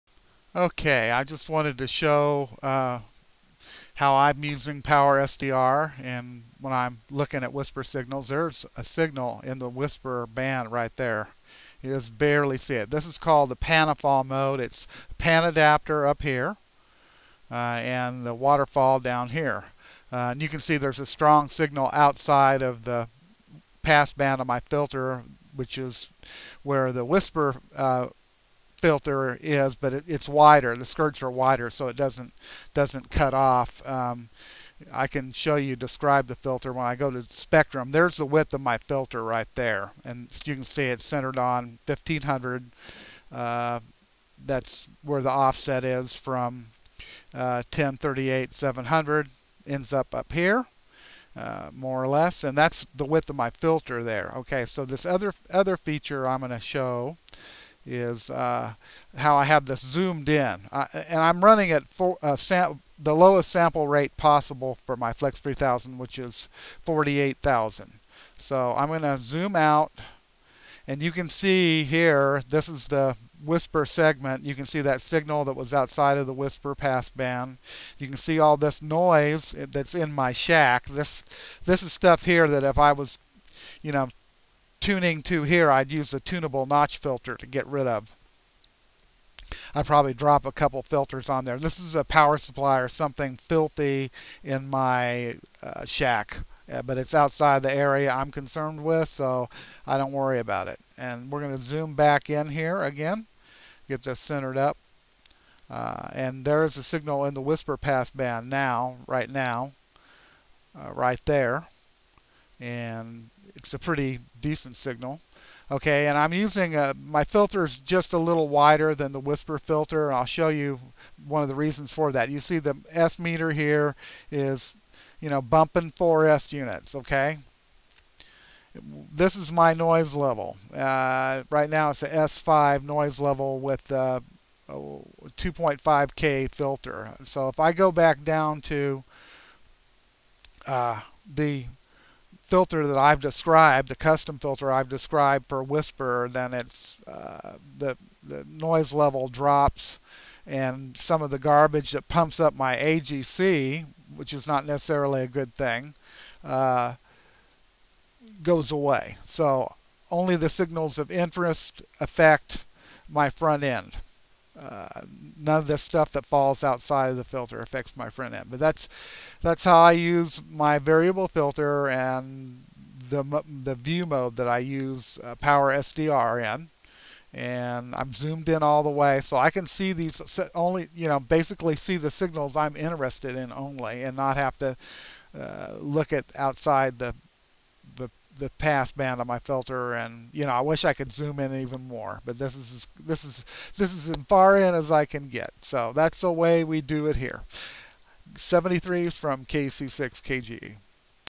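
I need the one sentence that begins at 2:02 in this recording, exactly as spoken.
You see the S meter here is, you know, bumping 4S units, okay?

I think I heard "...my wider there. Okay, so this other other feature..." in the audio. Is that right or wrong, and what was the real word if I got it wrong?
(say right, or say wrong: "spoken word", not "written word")
wrong: "filter", not "wider".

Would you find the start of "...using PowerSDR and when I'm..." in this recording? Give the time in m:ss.
0:04.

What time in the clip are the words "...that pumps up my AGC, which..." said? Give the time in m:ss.
2:31.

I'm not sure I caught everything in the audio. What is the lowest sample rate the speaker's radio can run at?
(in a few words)
48,000.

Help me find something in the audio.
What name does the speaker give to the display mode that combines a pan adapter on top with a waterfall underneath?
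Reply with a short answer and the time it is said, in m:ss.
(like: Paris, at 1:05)
Panafall, at 0:13.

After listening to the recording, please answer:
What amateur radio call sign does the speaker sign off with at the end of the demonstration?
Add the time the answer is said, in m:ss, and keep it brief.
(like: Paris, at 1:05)
KC6KGE, at 3:19.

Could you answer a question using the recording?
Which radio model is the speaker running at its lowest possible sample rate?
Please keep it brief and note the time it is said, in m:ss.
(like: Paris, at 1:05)
Flex 3000, at 1:05.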